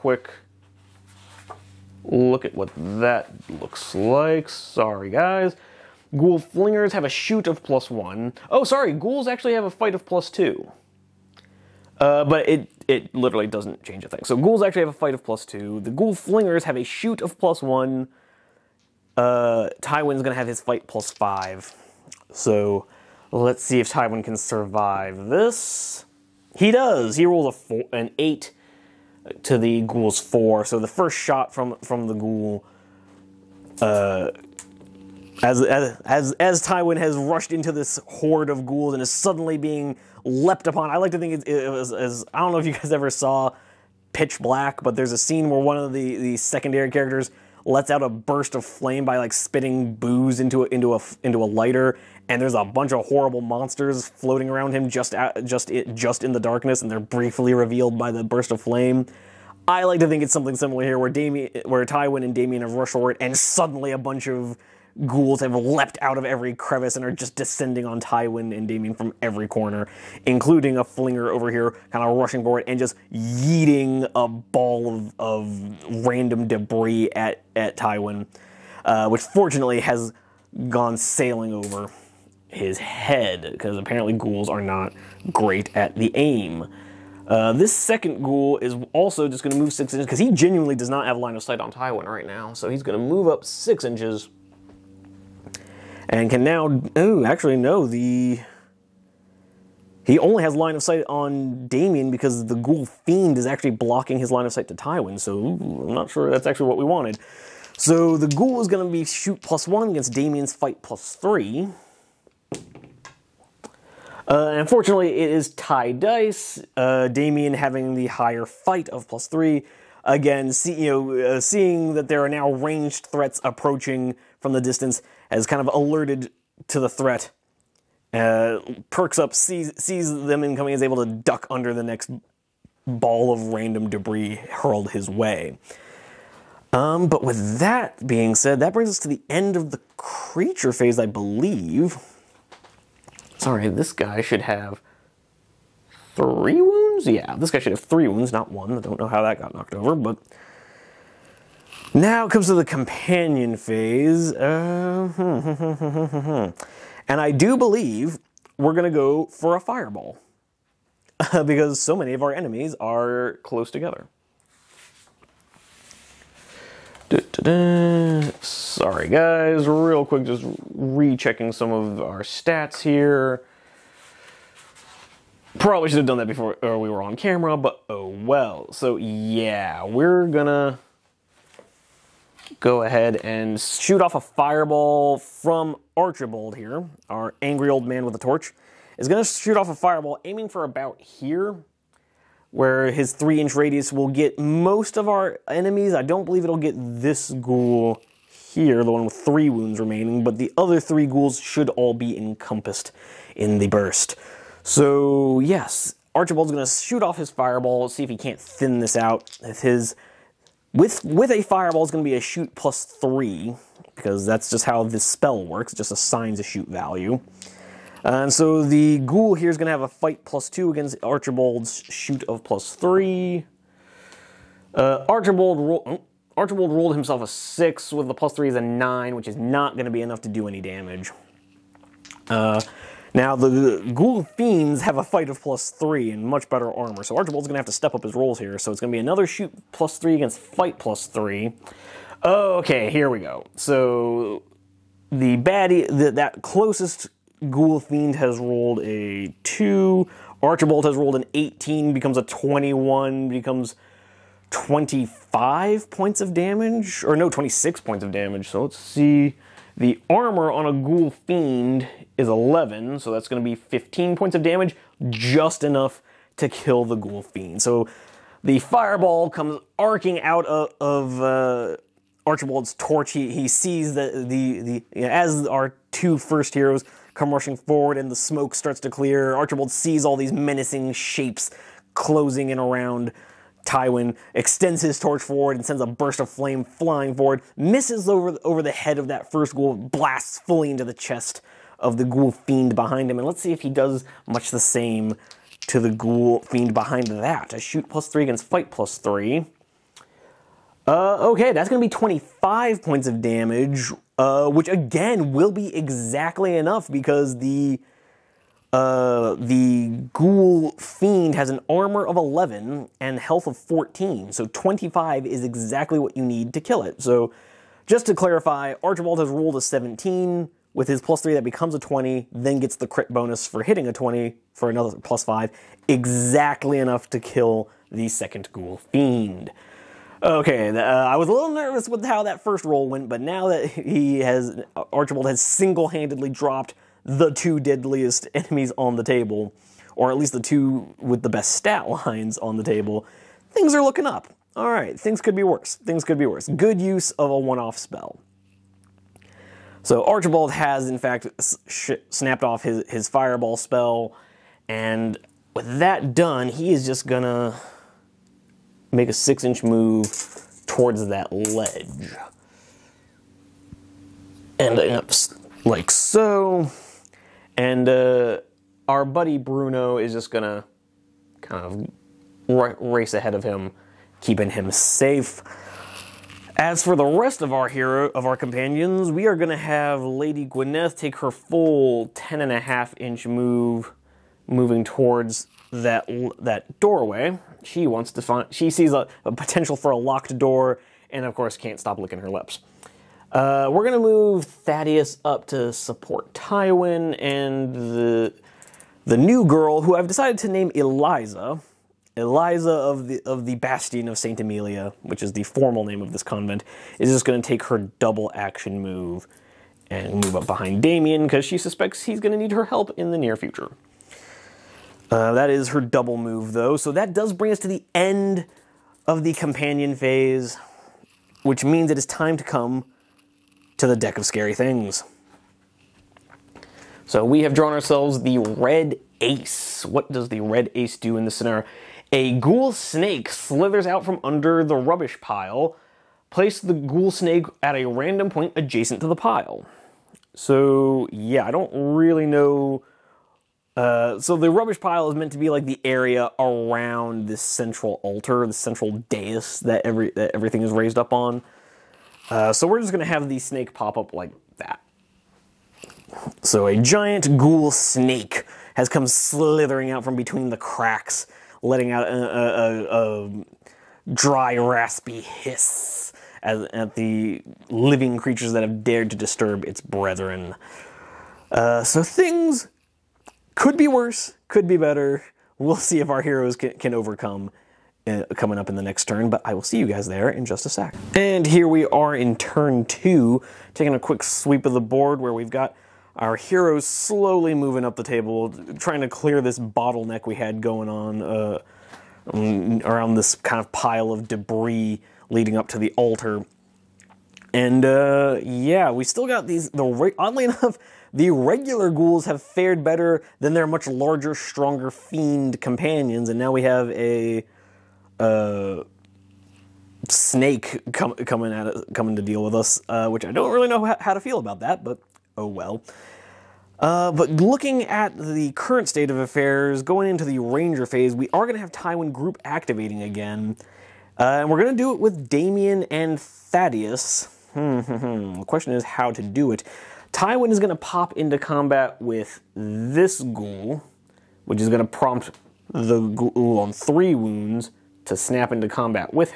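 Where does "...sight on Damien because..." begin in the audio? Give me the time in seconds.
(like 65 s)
100 s.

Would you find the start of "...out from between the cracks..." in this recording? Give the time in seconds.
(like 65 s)
459 s.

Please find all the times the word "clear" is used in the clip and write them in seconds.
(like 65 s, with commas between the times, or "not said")
278 s, 489 s.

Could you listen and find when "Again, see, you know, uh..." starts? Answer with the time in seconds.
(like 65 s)
120 s.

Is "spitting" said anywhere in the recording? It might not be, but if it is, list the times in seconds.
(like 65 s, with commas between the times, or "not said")
49 s.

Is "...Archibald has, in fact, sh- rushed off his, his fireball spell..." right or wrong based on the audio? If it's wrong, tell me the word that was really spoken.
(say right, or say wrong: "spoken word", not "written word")
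wrong: "snapped", not "rushed".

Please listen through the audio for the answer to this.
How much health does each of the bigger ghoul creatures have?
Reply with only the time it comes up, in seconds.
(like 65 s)
313 s.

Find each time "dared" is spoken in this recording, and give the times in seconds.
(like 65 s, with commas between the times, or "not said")
468 s.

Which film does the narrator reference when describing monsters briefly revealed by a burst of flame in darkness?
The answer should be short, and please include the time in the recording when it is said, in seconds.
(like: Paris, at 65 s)
Pitch Black, at 44 s.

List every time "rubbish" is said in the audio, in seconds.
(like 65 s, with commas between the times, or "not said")
434 s, 444 s.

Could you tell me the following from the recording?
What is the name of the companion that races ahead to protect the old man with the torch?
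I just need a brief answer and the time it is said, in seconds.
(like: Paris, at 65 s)
Bruno, at 369 s.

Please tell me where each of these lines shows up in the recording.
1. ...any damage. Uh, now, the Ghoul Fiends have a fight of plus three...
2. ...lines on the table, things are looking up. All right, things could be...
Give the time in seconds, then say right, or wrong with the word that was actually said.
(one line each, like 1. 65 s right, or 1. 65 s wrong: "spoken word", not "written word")
1. 230 s right
2. 342 s right.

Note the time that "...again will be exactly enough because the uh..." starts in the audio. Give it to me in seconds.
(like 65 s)
304 s.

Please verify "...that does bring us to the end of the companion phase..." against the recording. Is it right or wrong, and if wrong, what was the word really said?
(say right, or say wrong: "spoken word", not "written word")
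right.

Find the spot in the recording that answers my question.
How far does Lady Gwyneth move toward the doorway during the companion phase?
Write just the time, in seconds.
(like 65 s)
382 s.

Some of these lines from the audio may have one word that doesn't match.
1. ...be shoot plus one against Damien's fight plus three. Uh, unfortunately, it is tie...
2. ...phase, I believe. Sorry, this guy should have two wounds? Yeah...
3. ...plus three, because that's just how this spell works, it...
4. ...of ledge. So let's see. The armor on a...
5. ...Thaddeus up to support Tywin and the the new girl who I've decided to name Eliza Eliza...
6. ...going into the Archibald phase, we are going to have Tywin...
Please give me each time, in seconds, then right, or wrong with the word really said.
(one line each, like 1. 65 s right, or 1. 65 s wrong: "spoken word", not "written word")
1. 108 s right
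2. 140 s wrong: "three", not "two"
3. 212 s right
4. 258 s wrong: "damage", not "ledge"
5. 394 s right
6. 519 s wrong: "Ranger", not "Archibald".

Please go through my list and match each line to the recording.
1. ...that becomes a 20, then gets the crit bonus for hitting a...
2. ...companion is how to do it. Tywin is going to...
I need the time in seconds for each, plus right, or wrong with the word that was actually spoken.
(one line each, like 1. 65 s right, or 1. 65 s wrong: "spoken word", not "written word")
1. 321 s right
2. 528 s wrong: "question", not "companion".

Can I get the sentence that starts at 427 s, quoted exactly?
So we have drawn ourselves the red ace.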